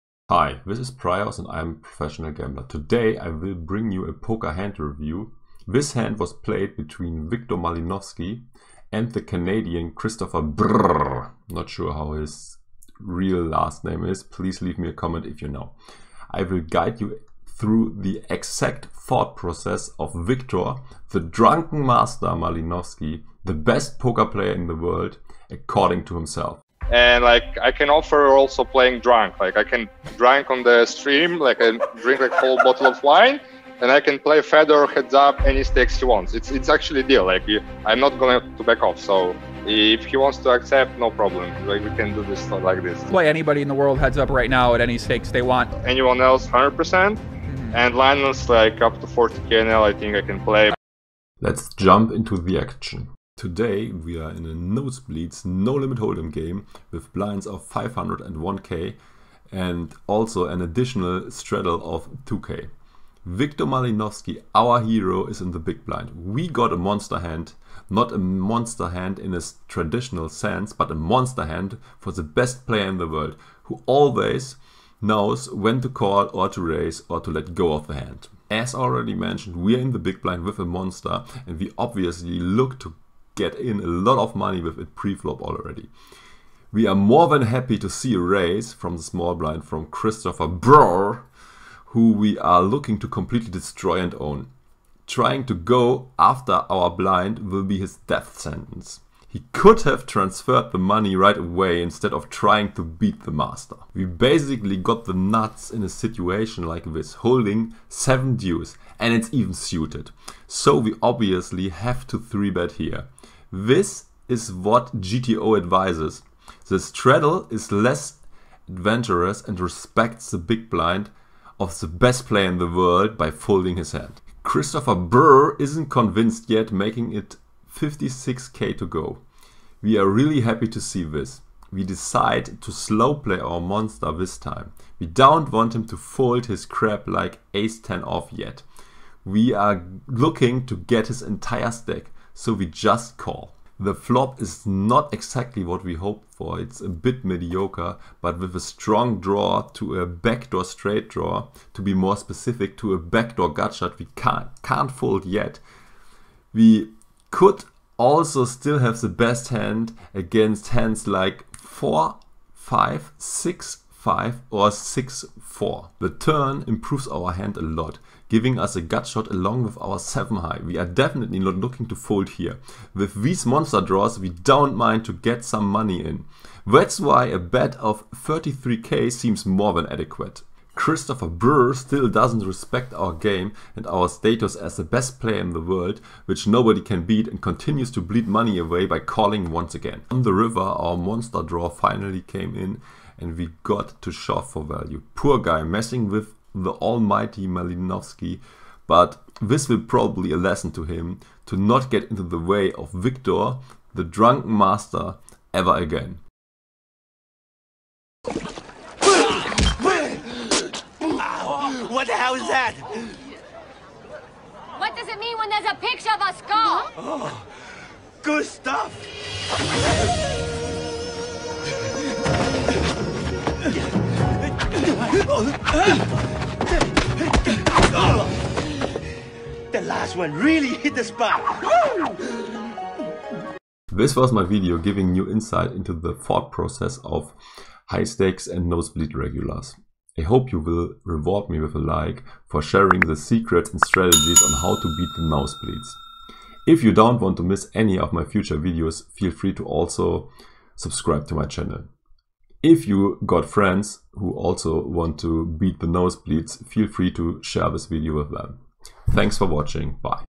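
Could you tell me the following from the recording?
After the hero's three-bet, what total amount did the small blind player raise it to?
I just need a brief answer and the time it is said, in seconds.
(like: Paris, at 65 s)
56k, at 127 s.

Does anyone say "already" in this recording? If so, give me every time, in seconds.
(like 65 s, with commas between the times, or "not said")
78 s, 85 s.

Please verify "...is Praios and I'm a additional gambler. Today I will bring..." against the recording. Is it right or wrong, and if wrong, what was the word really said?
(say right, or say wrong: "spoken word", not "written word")
wrong: "professional", not "additional".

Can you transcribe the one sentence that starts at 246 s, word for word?
If you don't want to miss any of my future videos, feel free to also subscribe to my channel.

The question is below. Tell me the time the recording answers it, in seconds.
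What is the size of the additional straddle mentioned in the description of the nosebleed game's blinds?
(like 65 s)
62 s.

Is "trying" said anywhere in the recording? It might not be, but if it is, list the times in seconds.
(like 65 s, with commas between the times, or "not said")
95 s, 102 s.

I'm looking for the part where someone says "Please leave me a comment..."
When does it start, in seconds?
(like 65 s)
14 s.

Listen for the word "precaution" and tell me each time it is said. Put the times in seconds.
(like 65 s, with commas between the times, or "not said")
not said.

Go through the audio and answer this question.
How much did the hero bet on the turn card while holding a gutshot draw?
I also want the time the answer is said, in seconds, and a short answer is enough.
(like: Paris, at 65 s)
33k, at 178 s.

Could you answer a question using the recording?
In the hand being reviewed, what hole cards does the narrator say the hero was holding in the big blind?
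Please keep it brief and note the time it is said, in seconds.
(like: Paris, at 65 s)
7 deuce suited, at 107 s.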